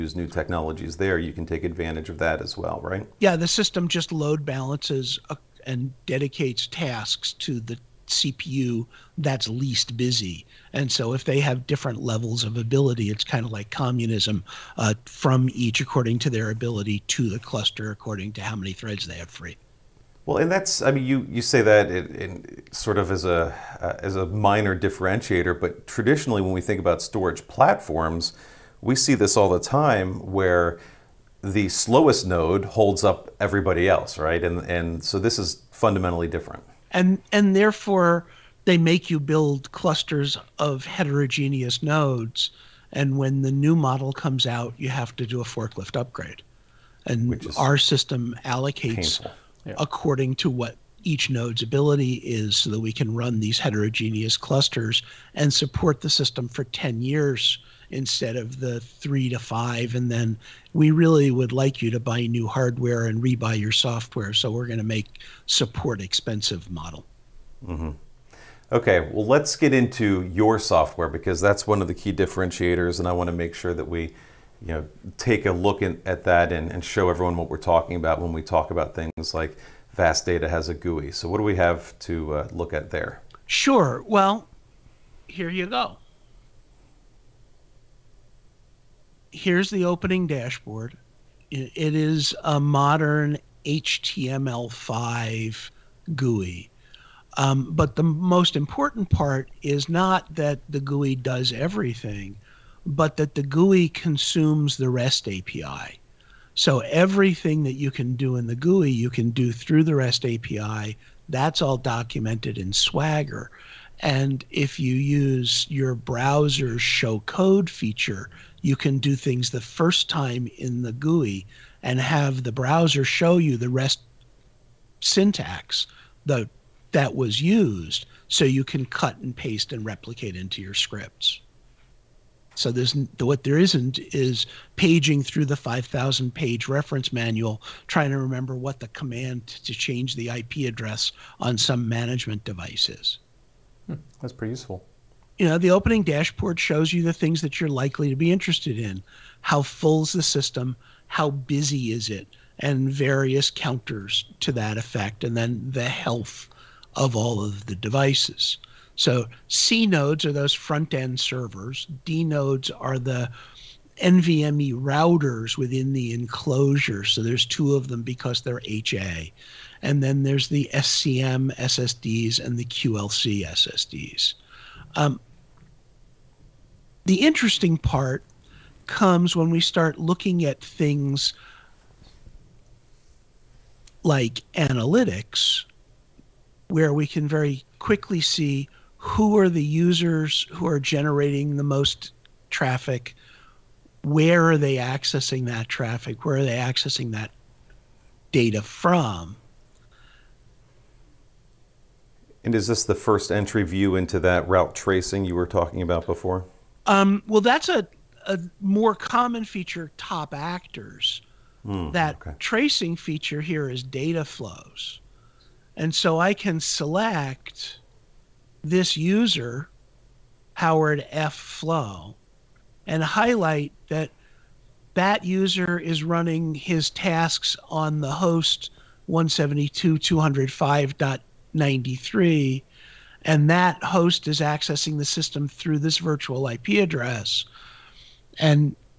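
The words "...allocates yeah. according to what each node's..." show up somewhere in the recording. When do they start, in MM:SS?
00:48.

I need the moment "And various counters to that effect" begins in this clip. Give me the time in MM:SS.
02:32.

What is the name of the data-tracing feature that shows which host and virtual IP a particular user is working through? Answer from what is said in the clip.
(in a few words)
data flows.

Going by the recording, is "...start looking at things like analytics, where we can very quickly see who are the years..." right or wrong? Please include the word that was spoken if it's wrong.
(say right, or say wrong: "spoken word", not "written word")
wrong: "users", not "years".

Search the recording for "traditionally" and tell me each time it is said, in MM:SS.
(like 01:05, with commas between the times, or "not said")
00:25.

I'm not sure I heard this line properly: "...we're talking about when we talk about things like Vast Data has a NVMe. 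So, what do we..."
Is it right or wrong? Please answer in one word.
wrong.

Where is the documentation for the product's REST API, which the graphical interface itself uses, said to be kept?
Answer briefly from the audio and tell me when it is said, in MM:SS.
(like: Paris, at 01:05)
Swagger, at 01:52.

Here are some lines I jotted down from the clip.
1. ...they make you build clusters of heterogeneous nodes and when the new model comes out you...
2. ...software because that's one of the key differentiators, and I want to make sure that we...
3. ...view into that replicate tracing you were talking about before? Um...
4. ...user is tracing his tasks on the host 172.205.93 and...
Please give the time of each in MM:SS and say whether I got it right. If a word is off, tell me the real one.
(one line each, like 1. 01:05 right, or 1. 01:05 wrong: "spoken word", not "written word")
1. 00:38 right
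2. 01:10 right
3. 03:23 wrong: "route", not "replicate"
4. 03:45 wrong: "running", not "tracing".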